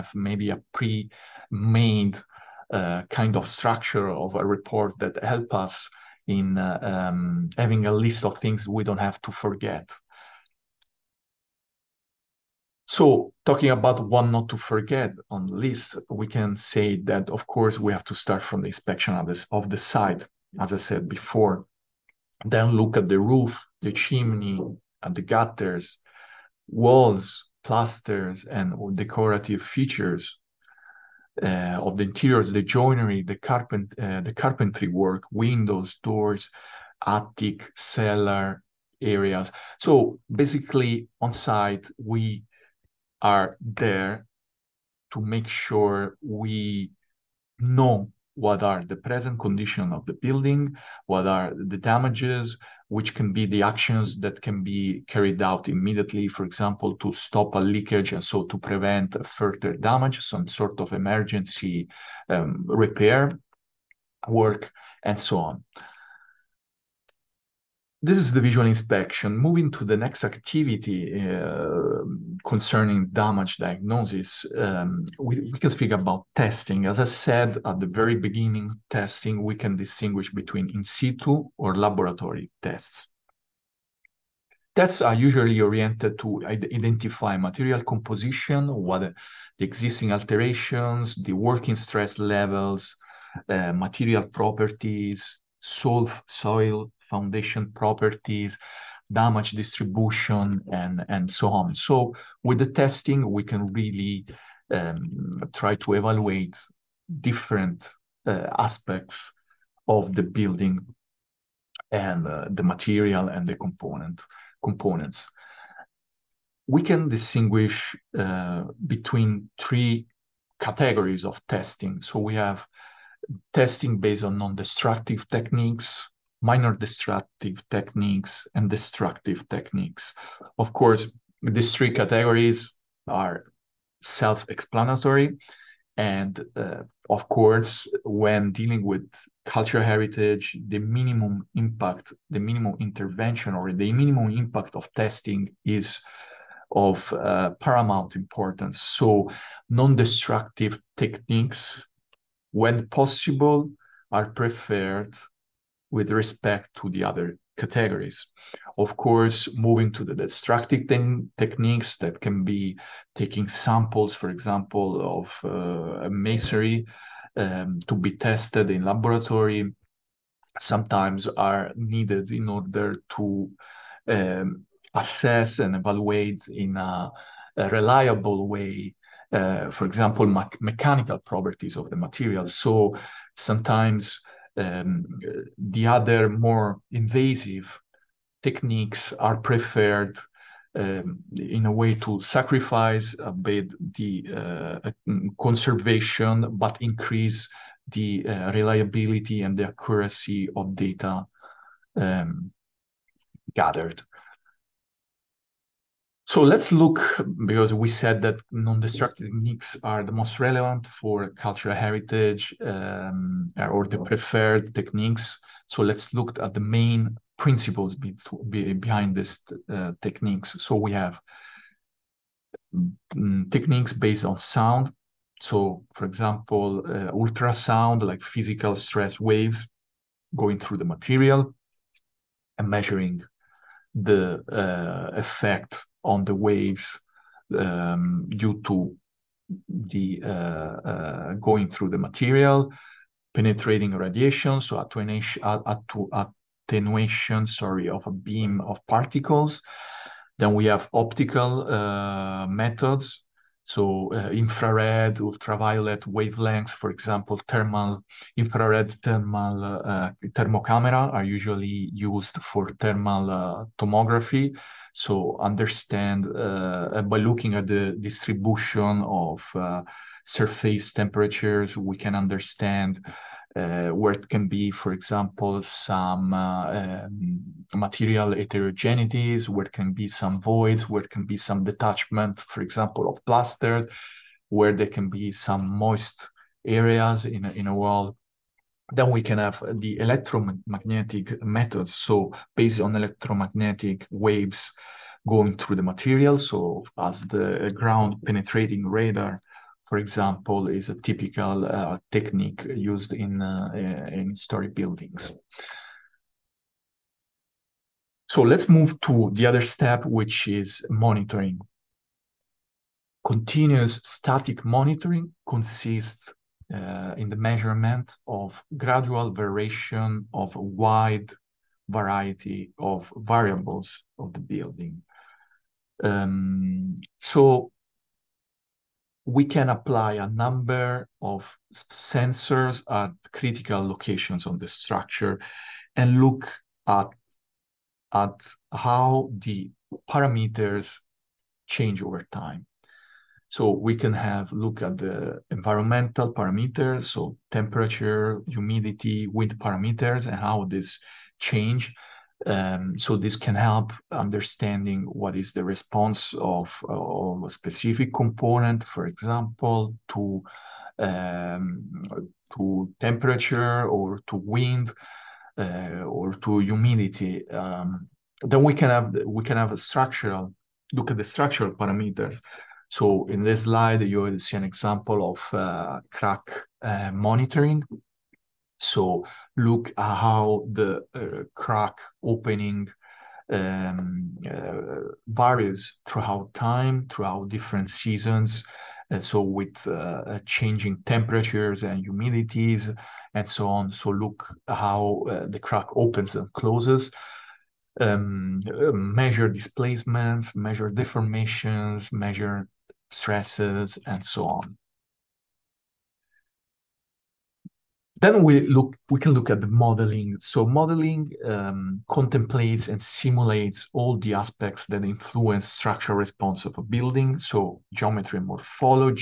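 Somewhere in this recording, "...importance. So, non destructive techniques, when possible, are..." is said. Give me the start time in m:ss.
2:28.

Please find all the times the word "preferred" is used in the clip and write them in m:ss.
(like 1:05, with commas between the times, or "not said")
2:34, 3:09, 3:33.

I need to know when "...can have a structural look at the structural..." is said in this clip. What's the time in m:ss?
6:09.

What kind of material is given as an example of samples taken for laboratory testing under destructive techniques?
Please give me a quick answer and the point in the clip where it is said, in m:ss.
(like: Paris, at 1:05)
masonry, at 2:46.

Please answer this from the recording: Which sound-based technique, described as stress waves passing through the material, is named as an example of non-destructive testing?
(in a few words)
ultrasound.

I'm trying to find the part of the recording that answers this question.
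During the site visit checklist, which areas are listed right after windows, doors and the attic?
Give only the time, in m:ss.
0:37.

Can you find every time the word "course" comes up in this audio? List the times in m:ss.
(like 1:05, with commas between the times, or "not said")
0:17, 2:10, 2:17, 2:38.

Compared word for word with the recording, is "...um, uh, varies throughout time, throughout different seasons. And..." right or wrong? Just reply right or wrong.
right.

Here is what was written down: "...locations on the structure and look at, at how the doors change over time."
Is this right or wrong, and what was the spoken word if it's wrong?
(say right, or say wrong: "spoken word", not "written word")
wrong: "parameters", not "doors".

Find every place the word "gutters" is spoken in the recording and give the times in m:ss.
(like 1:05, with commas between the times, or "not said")
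0:25.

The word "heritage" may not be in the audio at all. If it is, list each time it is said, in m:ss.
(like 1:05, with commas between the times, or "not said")
2:19, 3:31.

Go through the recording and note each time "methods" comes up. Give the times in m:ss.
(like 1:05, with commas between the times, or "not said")
4:12, 4:51.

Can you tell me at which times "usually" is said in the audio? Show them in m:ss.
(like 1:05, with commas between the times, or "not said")
1:25, 4:21.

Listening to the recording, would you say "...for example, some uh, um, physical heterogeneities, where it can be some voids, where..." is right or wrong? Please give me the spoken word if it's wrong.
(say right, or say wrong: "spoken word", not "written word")
wrong: "material", not "physical".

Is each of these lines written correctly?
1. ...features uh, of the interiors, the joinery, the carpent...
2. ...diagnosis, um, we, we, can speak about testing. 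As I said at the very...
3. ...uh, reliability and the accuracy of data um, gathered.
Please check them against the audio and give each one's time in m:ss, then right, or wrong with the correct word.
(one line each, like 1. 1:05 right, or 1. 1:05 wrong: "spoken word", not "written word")
1. 0:29 right
2. 1:13 right
3. 3:18 right.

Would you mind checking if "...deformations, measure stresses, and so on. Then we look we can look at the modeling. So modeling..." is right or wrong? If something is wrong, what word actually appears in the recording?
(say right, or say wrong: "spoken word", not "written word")
right.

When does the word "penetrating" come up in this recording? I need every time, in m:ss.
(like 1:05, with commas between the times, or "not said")
4:03, 4:58.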